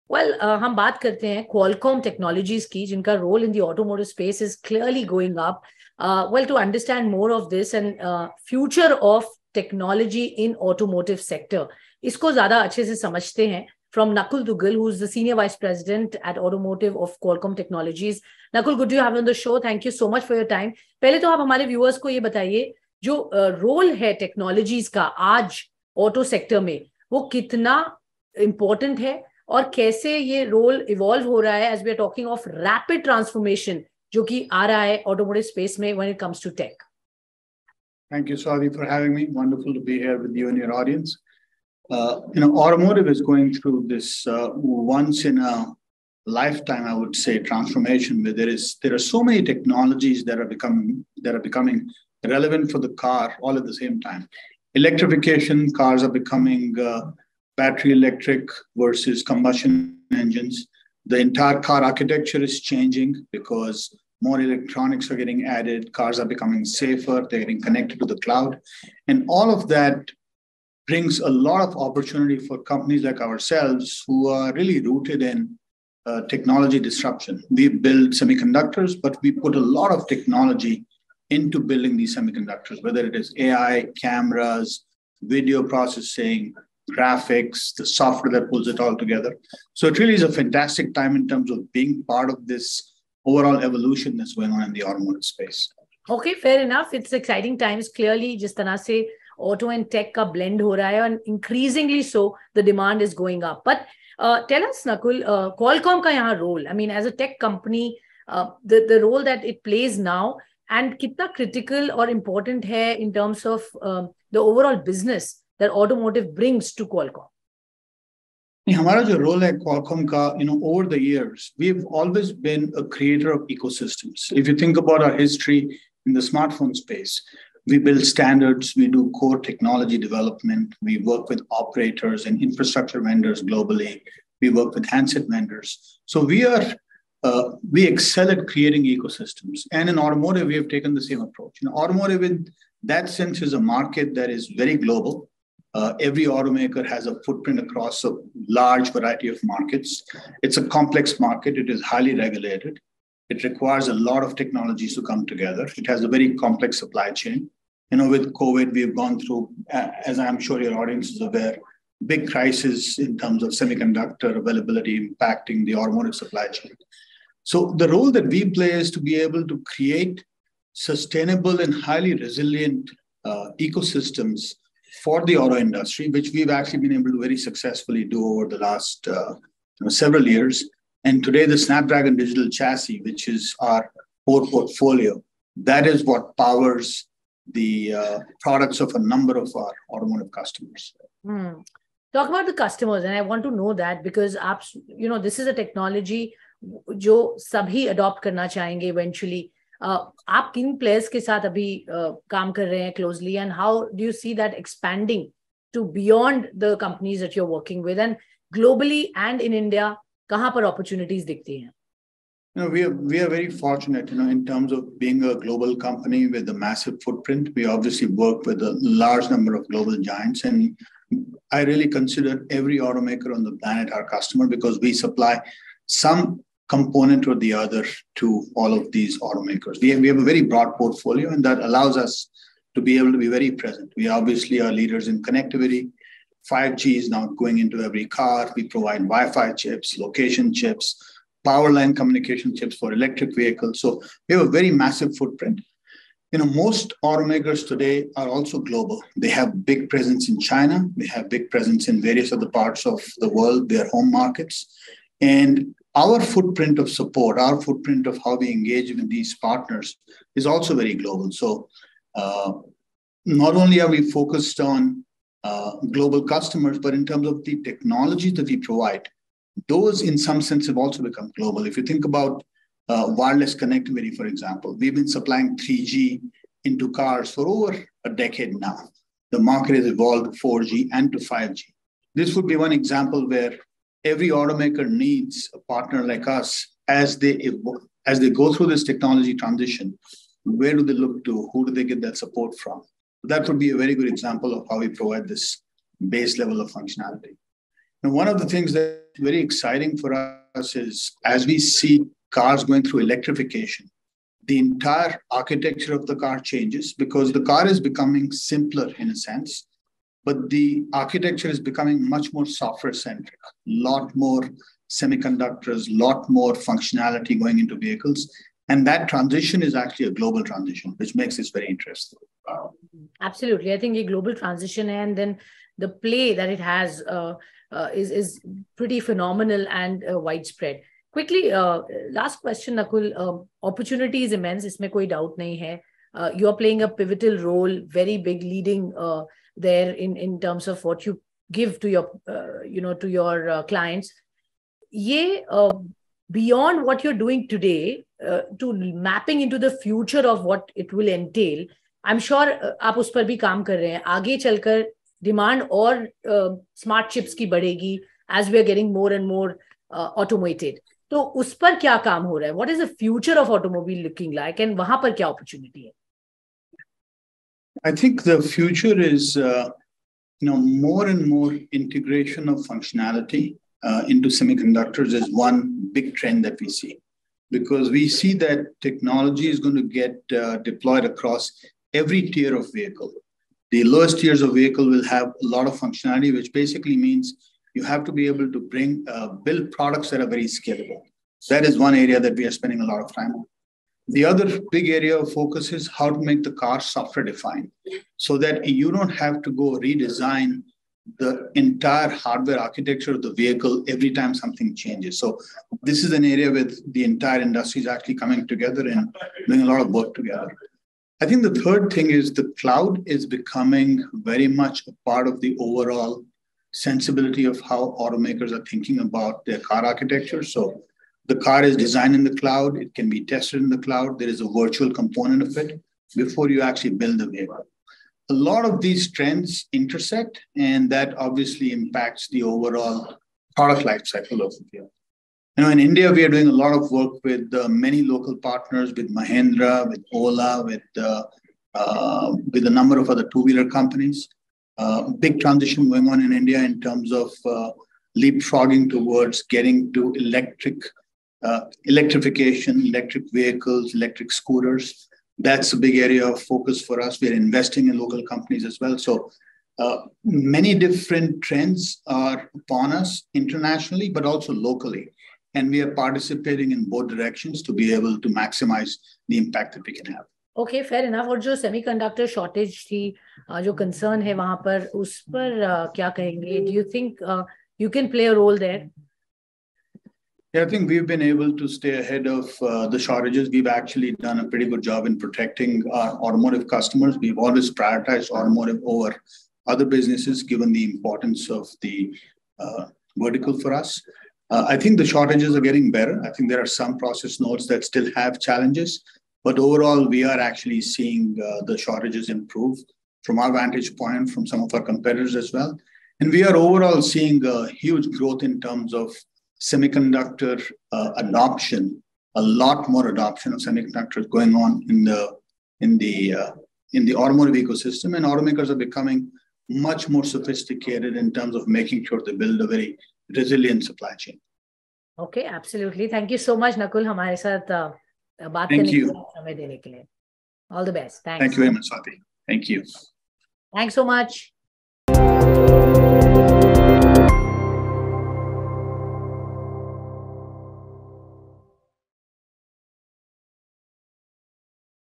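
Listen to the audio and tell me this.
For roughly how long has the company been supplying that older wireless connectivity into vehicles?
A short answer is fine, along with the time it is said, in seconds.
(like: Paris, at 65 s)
Over a decade, at 277 s.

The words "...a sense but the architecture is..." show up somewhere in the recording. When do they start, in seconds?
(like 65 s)
309 s.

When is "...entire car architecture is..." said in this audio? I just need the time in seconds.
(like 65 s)
61 s.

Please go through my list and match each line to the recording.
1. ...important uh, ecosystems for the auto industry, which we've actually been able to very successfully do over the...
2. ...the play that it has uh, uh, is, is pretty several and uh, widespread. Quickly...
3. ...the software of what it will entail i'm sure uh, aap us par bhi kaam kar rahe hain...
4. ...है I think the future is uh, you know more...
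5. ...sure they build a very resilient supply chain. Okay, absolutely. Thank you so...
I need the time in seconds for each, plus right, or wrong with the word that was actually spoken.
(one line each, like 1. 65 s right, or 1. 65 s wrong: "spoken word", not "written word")
1. 172 s wrong: "resilient", not "important"
2. 325 s wrong: "phenomenal", not "several"
3. 349 s wrong: "future", not "software"
4. 365 s right
5. 522 s right.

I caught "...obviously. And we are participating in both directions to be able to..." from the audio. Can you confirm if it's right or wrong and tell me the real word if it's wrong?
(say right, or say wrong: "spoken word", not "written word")
wrong: "locally", not "obviously".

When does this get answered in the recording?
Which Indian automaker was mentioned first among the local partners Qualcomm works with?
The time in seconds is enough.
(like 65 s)
439 s.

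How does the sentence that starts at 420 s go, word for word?
So the car is designed in the cloud.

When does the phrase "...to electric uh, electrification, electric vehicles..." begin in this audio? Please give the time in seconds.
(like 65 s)
449 s.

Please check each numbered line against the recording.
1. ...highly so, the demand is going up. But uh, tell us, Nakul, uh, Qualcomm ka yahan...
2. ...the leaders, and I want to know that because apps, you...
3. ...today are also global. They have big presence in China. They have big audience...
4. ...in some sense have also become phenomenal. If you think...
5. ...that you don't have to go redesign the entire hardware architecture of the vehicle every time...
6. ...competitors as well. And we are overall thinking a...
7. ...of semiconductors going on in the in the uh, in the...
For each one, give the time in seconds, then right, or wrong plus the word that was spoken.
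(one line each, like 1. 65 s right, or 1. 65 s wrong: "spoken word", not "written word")
1. 101 s wrong: "increasingly", not "highly"
2. 192 s wrong: "customers", not "leaders"
3. 247 s wrong: "presence", not "audience"
4. 270 s wrong: "global", not "phenomenal"
5. 398 s right
6. 504 s wrong: "seeing", not "thinking"
7. 513 s right.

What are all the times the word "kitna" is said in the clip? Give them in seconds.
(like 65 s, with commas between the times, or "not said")
110 s.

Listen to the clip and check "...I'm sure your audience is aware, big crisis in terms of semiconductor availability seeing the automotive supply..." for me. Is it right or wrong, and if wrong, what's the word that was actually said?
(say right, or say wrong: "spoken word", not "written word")
wrong: "impacting", not "seeing".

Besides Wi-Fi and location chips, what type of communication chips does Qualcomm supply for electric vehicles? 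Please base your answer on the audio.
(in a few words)
Power line communication.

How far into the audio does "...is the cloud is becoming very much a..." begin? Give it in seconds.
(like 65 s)
412 s.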